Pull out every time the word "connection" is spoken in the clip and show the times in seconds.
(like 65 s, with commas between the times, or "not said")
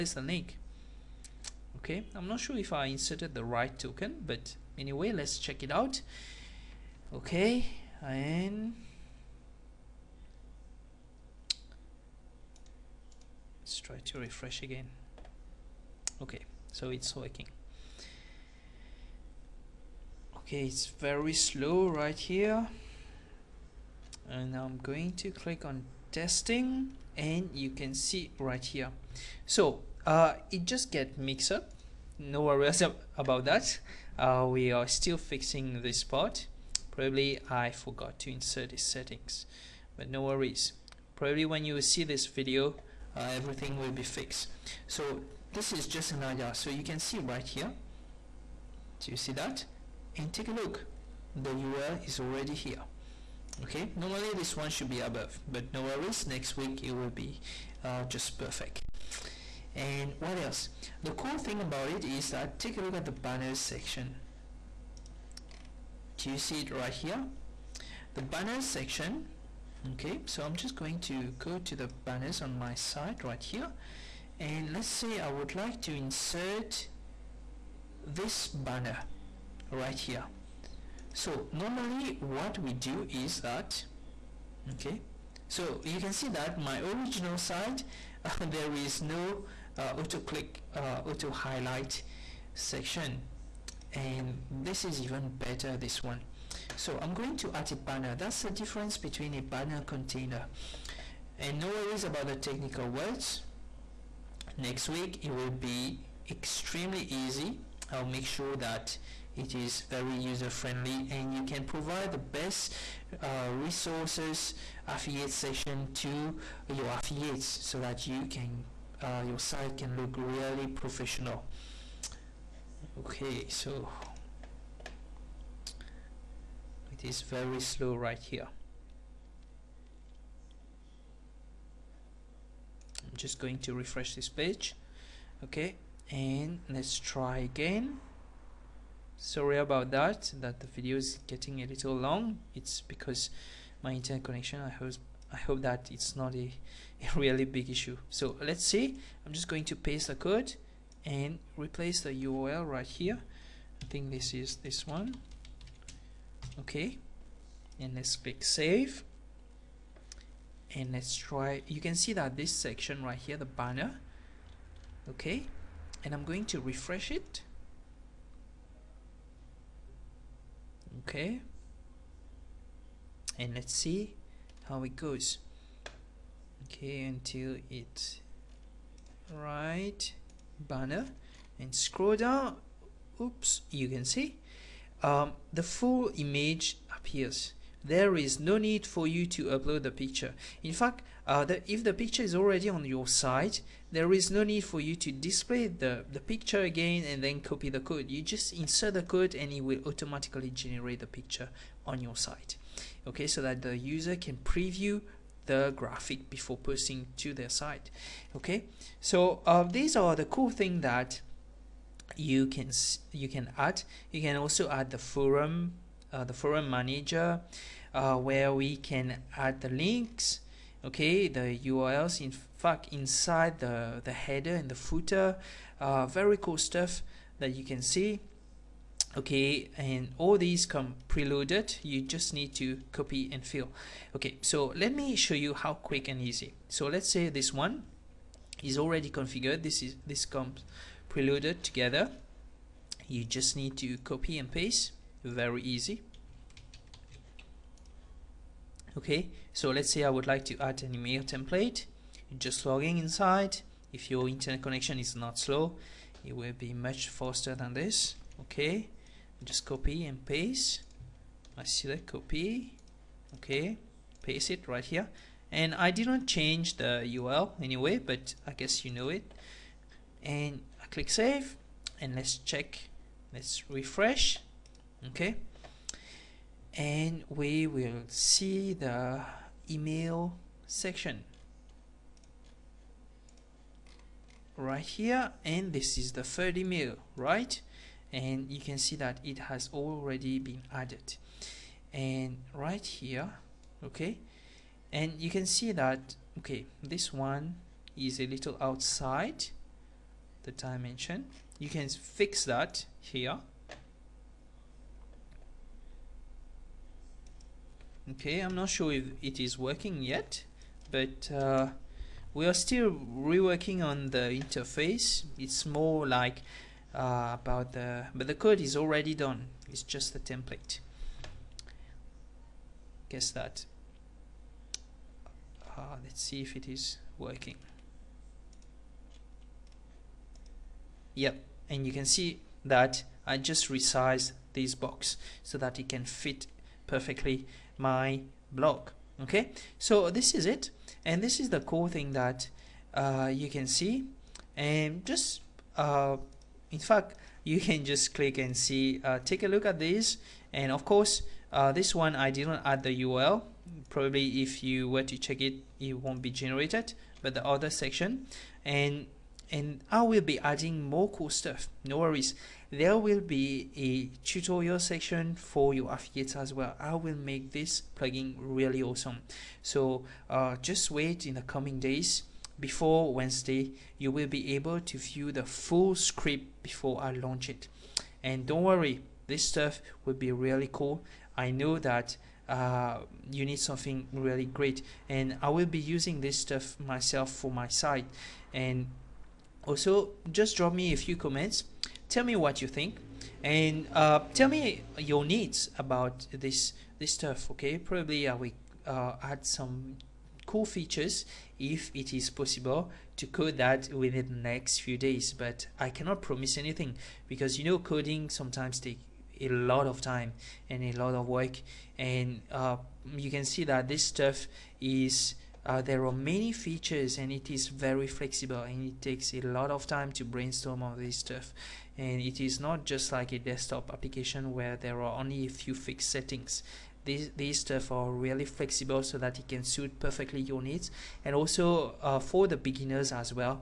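144 s, 254 s.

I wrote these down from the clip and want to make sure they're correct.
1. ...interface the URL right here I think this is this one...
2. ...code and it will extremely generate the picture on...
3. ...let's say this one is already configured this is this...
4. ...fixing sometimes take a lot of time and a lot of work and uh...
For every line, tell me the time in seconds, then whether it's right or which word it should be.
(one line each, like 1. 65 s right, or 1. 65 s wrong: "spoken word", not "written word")
1. 151 s wrong: "replace", not "interface"
2. 199 s wrong: "automatically", not "extremely"
3. 236 s right
4. 407 s wrong: "coding", not "fixing".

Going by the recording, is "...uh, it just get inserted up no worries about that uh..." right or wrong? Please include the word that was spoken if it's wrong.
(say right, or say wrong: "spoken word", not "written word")
wrong: "mixed", not "inserted".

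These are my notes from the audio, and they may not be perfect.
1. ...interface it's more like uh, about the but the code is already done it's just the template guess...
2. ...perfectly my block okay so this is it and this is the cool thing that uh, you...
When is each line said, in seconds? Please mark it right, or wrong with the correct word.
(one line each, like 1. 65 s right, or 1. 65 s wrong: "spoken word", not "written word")
1. 314 s right
2. 336 s right.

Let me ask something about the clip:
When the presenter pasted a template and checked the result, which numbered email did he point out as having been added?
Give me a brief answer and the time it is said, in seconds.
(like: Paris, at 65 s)
third, at 286 s.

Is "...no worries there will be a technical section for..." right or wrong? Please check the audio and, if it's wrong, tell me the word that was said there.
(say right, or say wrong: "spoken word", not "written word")
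wrong: "tutorial", not "technical".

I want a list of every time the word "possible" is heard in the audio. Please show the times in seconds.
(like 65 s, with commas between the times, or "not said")
402 s.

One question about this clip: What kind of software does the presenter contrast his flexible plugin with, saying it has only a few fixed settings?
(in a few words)
desktop application.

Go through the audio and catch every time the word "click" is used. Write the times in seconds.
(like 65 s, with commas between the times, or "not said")
25 s, 90 s, 158 s, 270 s, 348 s.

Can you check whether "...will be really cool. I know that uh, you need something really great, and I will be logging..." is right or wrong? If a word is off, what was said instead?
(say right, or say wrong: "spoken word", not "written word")
wrong: "using", not "logging".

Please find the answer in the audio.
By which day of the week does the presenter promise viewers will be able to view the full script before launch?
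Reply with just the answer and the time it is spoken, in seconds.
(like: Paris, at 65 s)
Wednesday, at 373 s.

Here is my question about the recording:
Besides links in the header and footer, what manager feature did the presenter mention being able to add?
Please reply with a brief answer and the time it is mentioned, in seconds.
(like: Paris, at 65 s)
forum manager, at 216 s.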